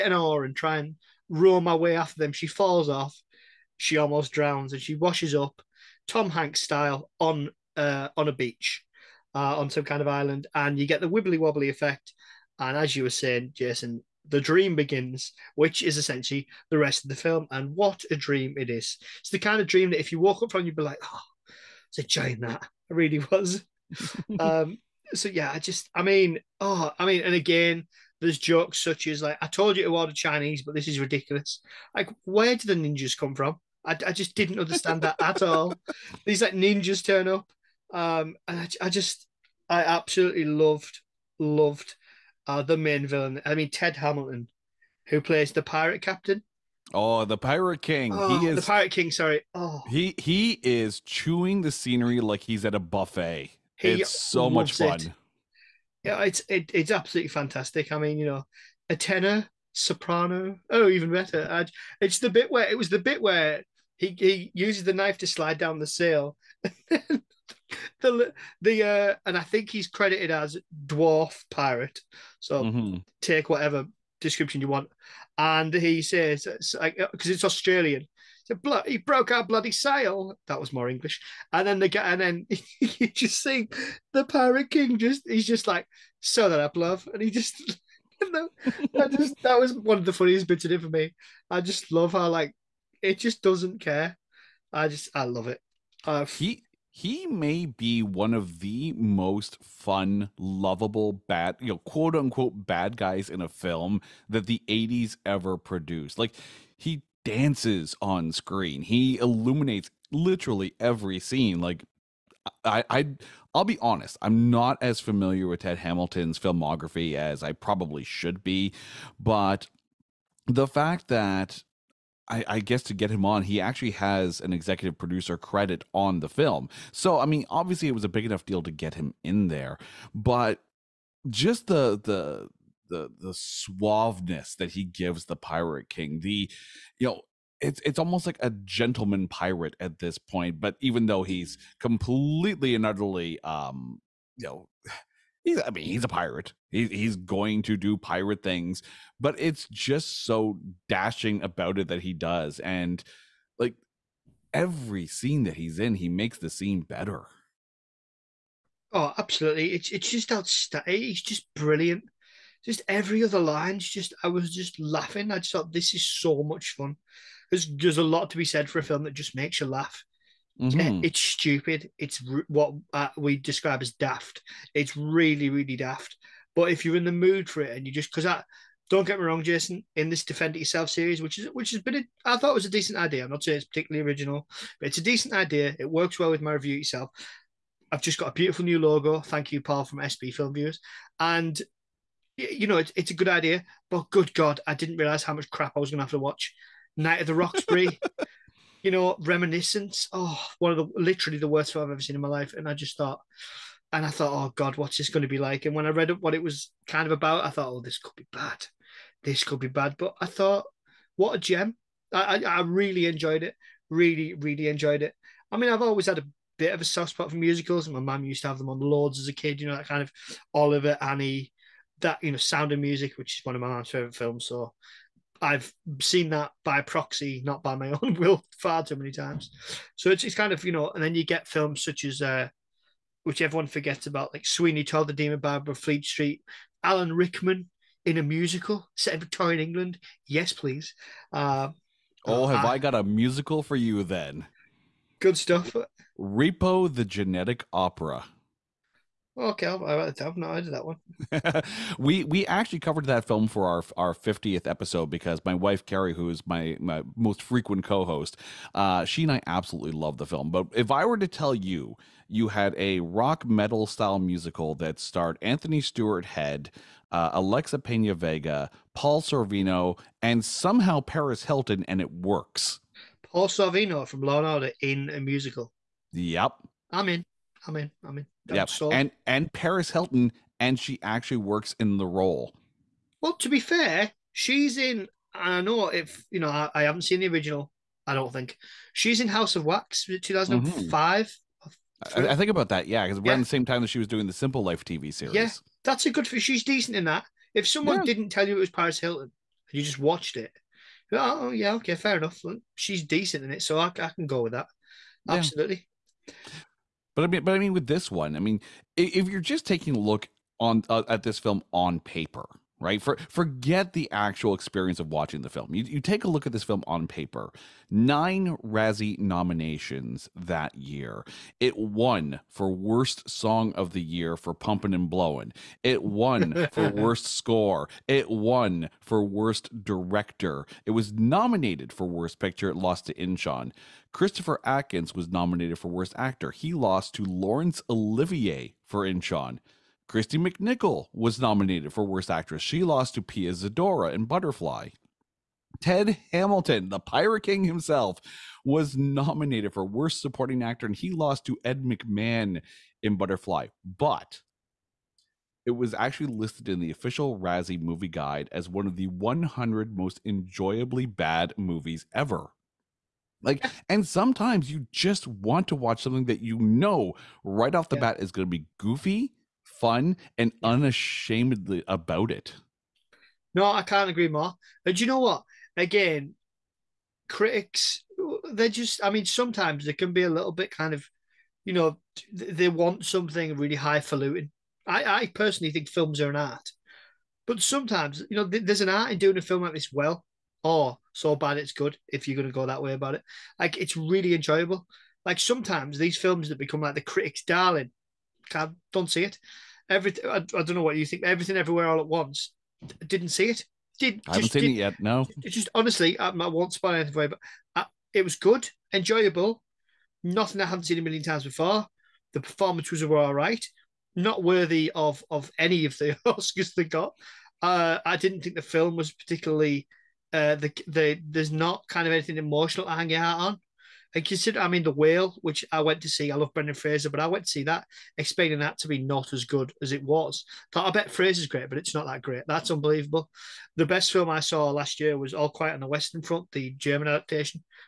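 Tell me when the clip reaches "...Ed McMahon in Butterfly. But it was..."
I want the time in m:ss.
5:51.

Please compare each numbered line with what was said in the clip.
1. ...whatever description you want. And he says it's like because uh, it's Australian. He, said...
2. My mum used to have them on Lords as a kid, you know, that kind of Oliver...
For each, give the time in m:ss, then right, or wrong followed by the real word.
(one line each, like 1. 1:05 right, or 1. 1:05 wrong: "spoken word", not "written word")
1. 1:13 right
2. 3:37 right.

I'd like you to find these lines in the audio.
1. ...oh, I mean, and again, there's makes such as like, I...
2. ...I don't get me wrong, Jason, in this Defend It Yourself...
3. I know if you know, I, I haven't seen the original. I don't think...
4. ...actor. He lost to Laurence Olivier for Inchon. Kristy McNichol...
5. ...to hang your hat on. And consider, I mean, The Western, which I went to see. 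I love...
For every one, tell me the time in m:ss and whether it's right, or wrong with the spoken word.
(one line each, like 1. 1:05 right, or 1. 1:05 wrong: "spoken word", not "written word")
1. 0:26 wrong: "jokes", not "makes"
2. 2:58 right
3. 4:45 right
4. 5:36 right
5. 7:02 wrong: "Whale", not "Western".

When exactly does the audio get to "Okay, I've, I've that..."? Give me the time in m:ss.
4:09.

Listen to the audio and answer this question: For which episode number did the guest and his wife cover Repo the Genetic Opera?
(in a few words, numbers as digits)
50.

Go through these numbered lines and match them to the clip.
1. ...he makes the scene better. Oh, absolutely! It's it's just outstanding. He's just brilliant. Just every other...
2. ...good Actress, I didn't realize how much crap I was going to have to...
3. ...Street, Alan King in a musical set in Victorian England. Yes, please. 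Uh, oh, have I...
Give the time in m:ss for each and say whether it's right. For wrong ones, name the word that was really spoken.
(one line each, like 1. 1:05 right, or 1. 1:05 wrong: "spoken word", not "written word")
1. 2:35 right
2. 3:14 wrong: "God", not "Actress"
3. 3:56 wrong: "Rickman", not "King".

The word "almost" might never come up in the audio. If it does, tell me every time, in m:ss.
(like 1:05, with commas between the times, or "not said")
0:03, 2:17.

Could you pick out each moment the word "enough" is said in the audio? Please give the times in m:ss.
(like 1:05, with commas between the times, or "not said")
2:08, 5:02.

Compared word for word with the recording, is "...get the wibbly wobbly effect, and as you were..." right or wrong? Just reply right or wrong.
right.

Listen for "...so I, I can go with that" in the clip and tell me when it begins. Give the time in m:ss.
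5:03.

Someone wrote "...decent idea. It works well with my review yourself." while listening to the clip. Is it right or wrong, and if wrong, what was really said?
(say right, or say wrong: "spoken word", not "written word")
right.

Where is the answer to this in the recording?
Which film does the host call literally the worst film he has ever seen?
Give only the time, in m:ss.
3:19.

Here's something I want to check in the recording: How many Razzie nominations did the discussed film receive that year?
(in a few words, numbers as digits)
9.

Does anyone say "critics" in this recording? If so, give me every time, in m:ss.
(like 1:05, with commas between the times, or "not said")
6:17, 6:37.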